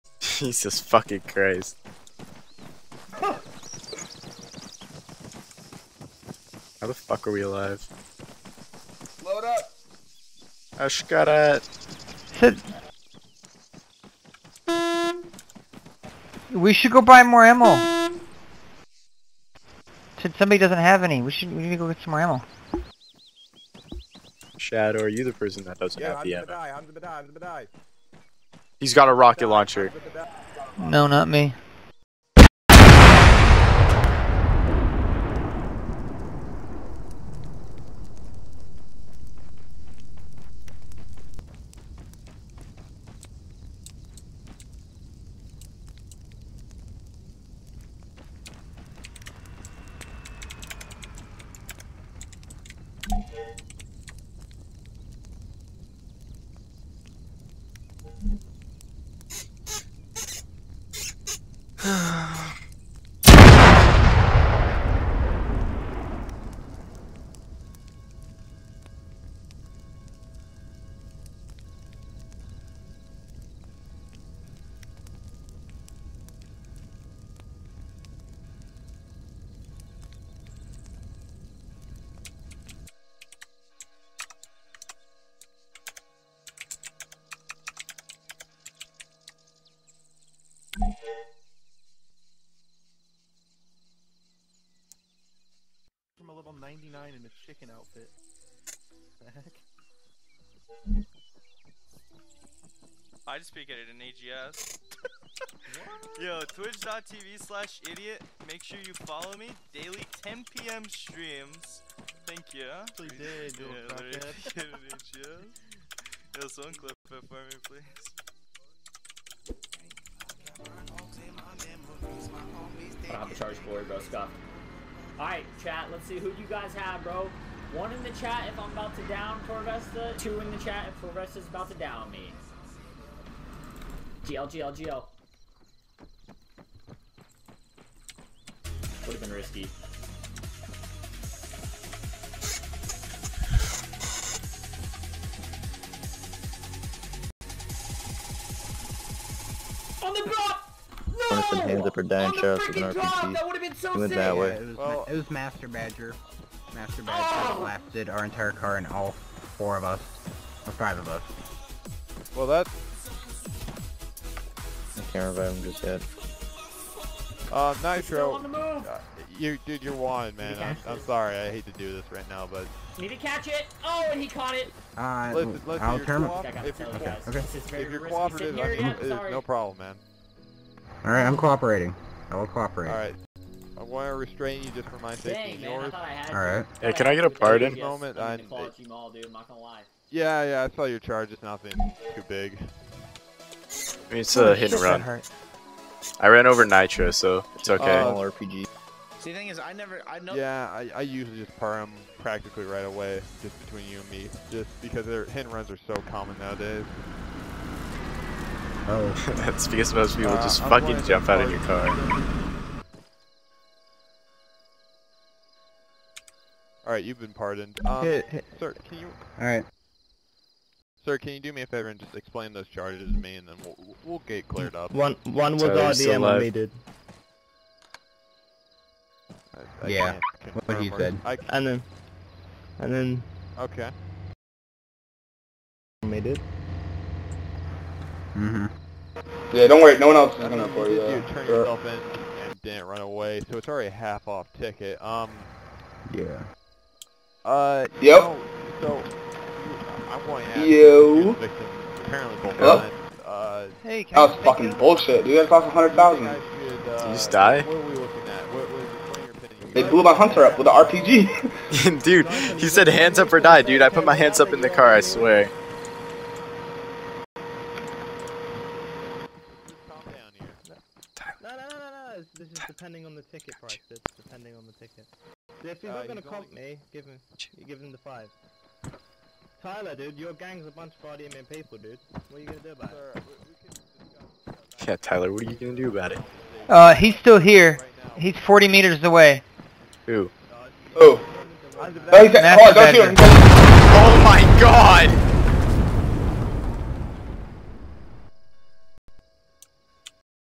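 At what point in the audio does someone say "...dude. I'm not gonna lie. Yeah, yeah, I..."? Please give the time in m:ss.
3:09.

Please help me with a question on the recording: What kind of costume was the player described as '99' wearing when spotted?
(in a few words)
chicken outfit.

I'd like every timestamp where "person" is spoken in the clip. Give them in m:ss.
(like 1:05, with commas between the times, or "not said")
0:25.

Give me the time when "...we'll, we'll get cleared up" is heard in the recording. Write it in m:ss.
3:43.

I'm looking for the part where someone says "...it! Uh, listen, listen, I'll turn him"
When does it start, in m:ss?
2:54.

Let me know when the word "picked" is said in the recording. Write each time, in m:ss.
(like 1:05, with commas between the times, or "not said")
not said.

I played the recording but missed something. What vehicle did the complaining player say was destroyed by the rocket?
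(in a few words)
hunter.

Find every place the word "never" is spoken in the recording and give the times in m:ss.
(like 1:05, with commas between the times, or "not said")
3:19.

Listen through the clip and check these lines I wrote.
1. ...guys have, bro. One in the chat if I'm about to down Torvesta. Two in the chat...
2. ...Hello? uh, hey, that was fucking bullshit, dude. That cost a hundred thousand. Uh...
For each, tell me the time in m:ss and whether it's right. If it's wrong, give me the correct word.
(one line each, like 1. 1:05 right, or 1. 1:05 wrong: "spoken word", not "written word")
1. 2:06 right
2. 4:12 right.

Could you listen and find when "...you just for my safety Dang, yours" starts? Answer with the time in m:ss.
3:04.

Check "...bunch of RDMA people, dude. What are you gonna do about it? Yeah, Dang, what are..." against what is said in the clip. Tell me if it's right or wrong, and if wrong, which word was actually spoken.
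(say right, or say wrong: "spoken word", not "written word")
wrong: "Tyler", not "Dang".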